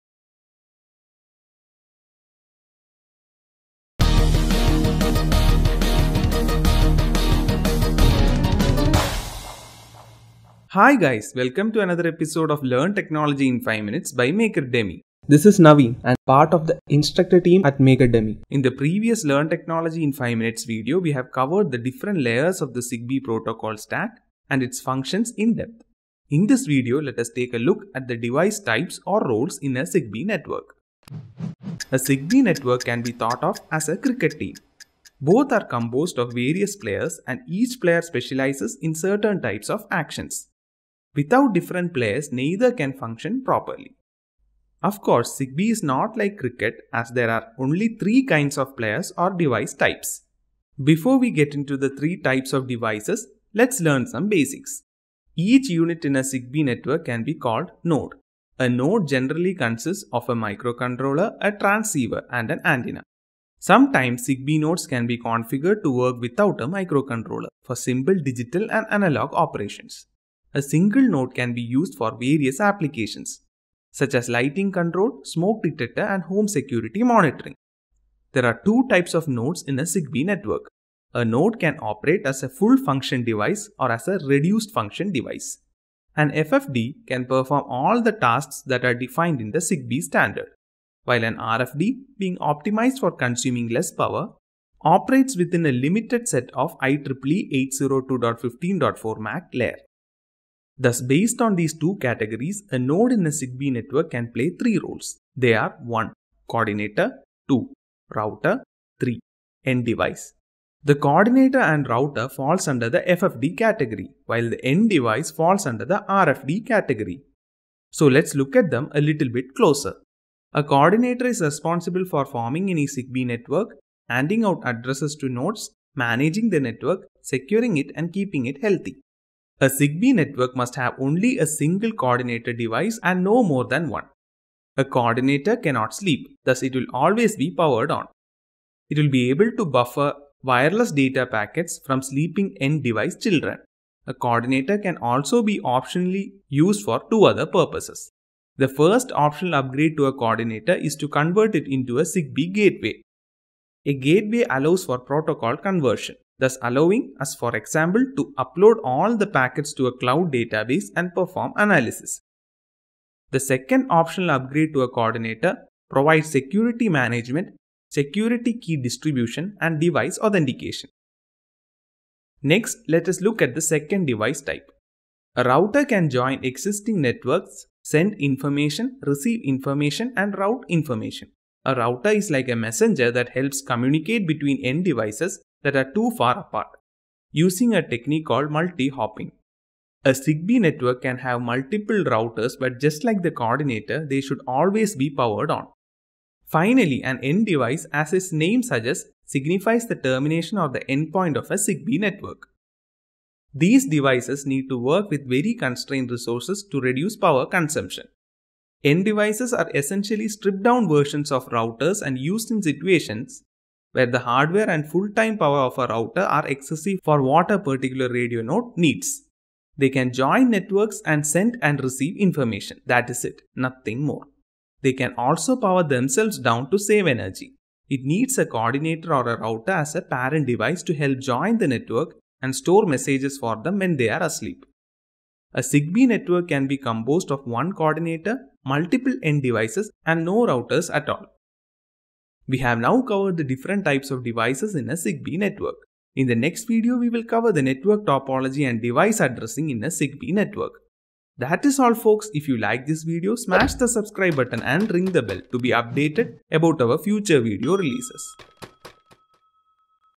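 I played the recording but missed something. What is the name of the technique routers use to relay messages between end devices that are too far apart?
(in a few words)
Multi-hopping.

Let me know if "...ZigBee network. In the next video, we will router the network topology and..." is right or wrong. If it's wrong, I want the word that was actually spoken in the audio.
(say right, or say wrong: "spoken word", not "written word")
wrong: "cover", not "router".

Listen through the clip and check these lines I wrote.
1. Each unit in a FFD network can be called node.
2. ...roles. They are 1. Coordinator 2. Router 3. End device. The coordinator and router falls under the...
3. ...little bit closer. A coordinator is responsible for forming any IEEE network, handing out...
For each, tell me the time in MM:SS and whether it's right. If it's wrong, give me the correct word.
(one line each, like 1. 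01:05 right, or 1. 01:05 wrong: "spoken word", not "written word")
1. 00:55 wrong: "Zigbee", not "FFD"
2. 01:44 right
3. 01:59 wrong: "ZigBee", not "IEEE".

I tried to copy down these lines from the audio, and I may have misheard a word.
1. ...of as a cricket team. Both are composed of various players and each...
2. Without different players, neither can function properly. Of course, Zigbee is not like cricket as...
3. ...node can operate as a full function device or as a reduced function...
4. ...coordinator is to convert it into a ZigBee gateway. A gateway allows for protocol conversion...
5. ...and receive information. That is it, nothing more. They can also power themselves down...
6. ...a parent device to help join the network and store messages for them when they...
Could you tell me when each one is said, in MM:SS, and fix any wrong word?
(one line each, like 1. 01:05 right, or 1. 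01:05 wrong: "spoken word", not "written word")
1. 00:33 right
2. 00:41 right
3. 01:21 right
4. 02:30 right
5. 03:41 right
6. 03:49 right.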